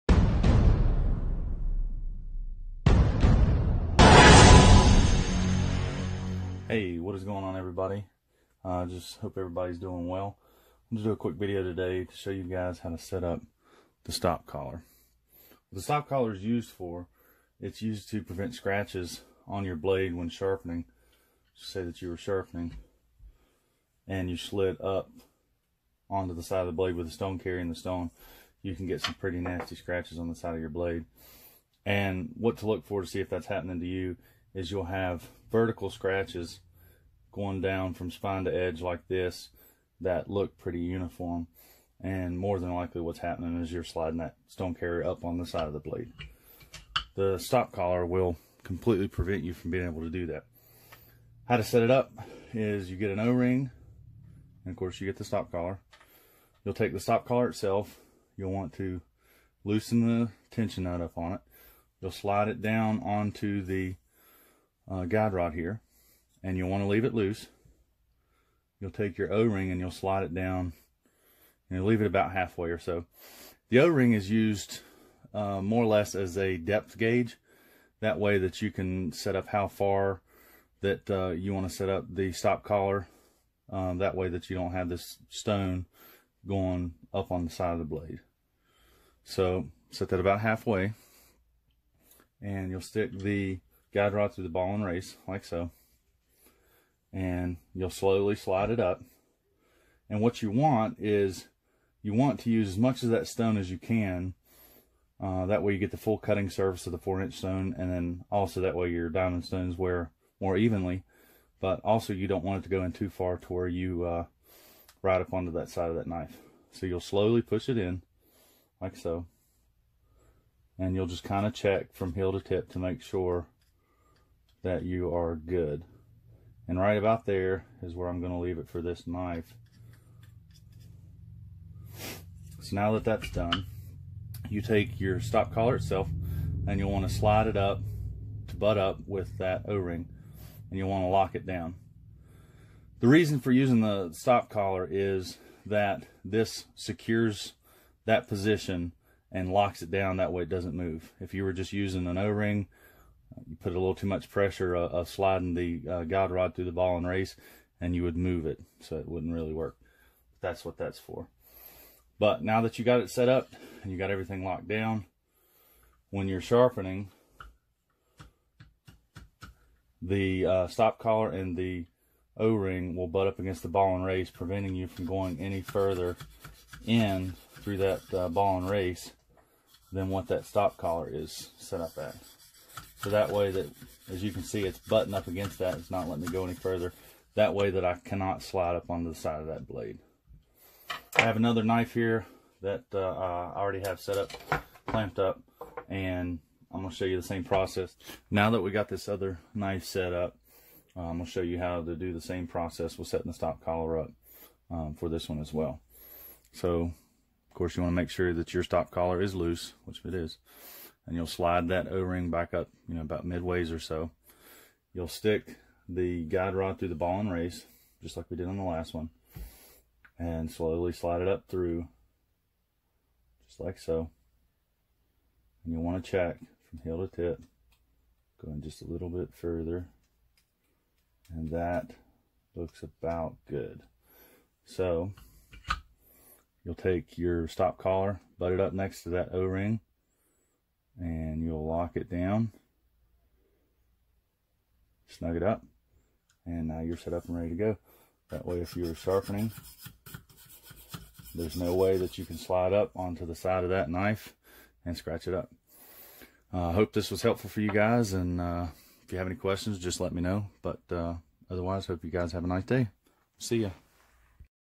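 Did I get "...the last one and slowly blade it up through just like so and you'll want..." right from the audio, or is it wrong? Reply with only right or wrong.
wrong.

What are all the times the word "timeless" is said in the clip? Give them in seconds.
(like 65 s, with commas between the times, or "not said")
not said.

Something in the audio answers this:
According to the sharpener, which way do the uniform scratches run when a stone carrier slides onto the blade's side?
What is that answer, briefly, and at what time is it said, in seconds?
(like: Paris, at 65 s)
spine to edge, at 37 s.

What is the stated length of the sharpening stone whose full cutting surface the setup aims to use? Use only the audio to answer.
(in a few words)
4 inch.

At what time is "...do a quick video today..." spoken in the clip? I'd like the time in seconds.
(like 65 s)
11 s.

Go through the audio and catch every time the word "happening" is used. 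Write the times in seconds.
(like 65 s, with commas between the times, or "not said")
33 s, 43 s.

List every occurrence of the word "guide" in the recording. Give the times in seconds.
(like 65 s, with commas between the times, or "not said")
65 s, 93 s, 156 s, 216 s.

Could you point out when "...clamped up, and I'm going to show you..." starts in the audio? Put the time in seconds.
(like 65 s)
194 s.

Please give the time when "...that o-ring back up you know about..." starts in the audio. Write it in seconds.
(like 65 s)
211 s.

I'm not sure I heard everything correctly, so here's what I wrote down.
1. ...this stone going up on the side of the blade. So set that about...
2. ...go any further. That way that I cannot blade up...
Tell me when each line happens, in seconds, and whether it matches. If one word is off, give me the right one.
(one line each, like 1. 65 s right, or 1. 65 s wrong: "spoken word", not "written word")
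1. 84 s right
2. 186 s wrong: "slide", not "blade".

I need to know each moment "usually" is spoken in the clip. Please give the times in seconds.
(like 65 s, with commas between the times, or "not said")
not said.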